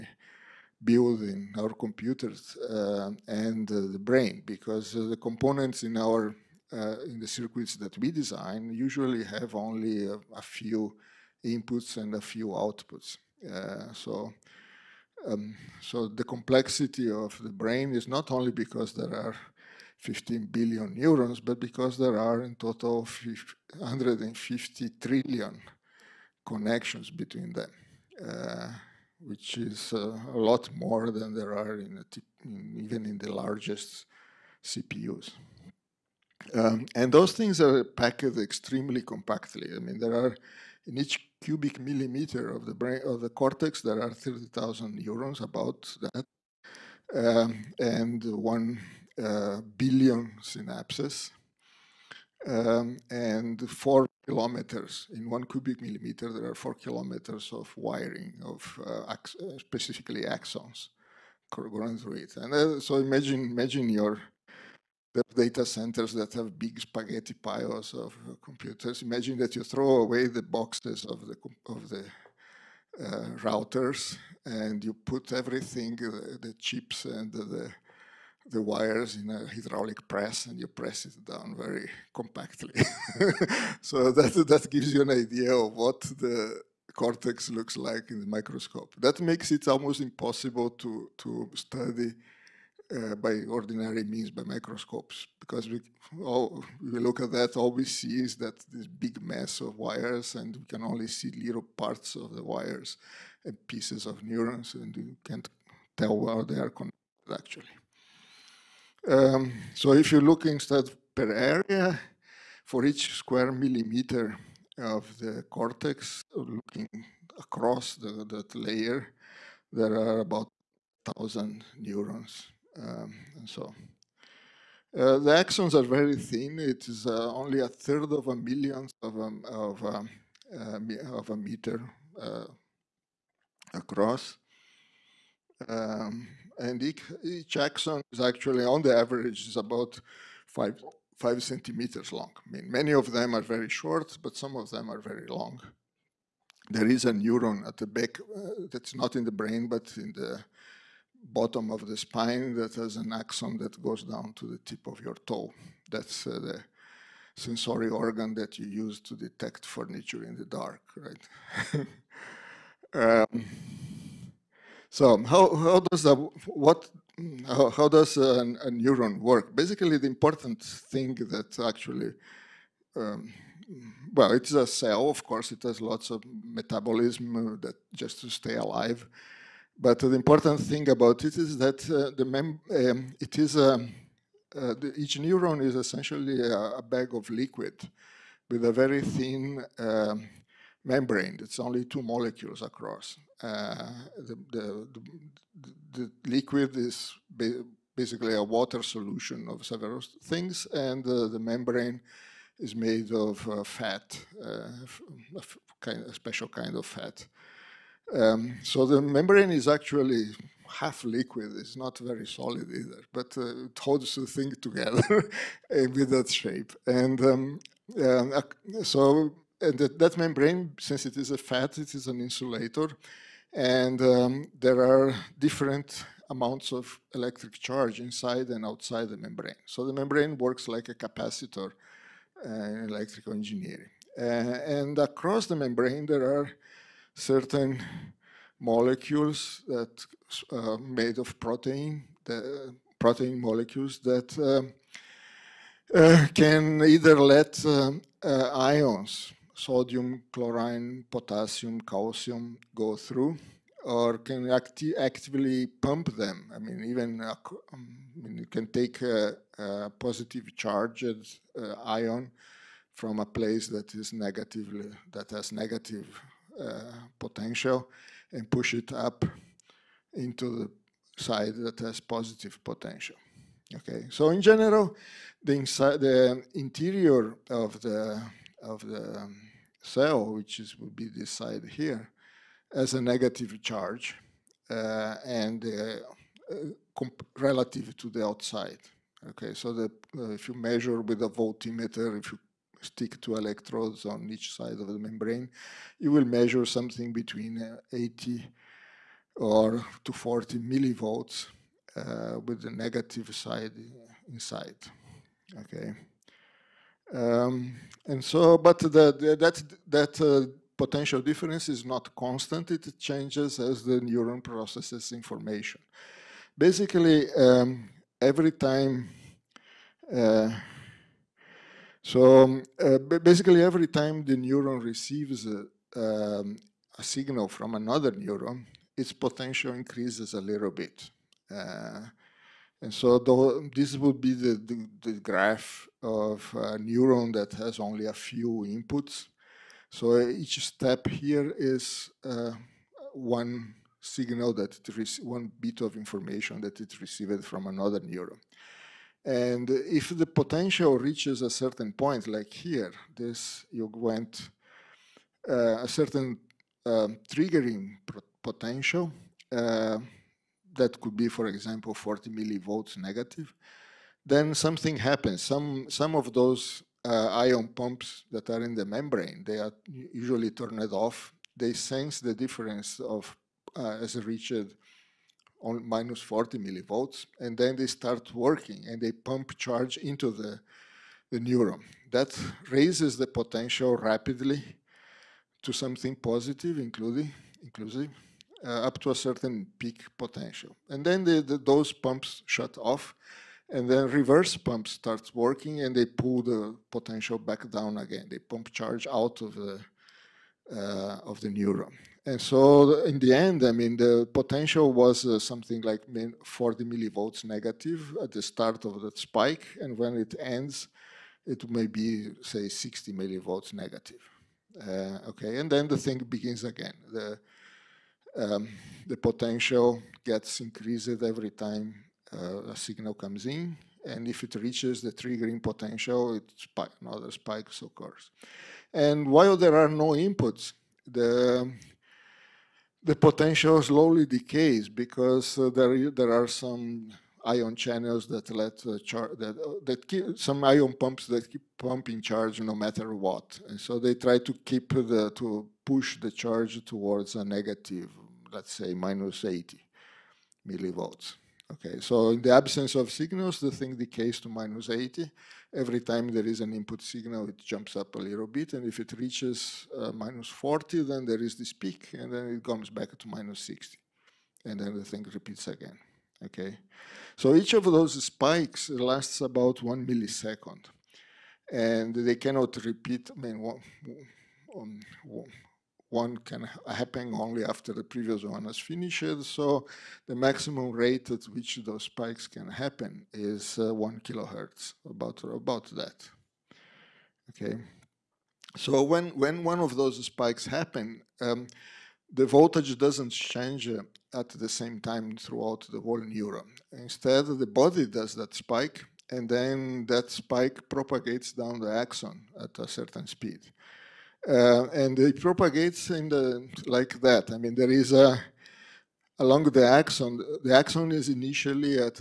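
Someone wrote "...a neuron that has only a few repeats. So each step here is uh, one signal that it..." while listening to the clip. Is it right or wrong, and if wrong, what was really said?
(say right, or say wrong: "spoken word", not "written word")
wrong: "inputs", not "repeats".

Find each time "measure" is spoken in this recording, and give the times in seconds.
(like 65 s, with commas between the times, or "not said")
290 s, 296 s.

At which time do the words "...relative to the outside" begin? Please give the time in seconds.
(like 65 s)
287 s.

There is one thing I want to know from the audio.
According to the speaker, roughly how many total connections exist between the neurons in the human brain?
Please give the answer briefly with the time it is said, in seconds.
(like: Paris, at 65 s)
150 trillion, at 23 s.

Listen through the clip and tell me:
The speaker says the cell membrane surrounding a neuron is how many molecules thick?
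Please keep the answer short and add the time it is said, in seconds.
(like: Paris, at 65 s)
2 molecules, at 191 s.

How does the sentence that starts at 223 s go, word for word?
And um, there are different amounts of electric charge inside and outside the membrane.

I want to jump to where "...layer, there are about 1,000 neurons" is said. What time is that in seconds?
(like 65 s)
118 s.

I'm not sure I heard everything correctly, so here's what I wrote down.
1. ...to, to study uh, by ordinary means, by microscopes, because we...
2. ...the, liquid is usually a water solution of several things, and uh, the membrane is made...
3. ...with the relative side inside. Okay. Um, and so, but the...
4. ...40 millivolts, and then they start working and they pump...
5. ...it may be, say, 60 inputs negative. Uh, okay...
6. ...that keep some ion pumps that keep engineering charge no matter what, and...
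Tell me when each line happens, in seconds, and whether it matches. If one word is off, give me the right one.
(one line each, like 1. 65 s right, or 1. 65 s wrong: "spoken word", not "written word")
1. 90 s right
2. 195 s wrong: "basically", not "usually"
3. 302 s wrong: "negative", not "relative"
4. 376 s right
5. 411 s wrong: "millivolts", not "inputs"
6. 439 s wrong: "pumping", not "engineering".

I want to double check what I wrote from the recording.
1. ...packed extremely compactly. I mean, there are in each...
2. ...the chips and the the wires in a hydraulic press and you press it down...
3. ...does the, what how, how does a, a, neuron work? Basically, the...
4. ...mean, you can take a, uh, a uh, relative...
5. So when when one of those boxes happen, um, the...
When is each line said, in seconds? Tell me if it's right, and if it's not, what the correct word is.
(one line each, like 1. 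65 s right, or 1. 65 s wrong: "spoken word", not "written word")
1. 37 s right
2. 76 s right
3. 165 s right
4. 258 s wrong: "positive", not "relative"
5. 488 s wrong: "spikes", not "boxes".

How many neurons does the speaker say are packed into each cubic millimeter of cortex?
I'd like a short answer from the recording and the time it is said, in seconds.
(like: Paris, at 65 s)
30,000, at 44 s.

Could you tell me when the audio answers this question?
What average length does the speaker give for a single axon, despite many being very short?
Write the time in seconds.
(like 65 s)
141 s.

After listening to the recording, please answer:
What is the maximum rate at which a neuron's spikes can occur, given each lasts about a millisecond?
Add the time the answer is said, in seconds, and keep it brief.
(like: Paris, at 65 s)
1 kilohertz, at 483 s.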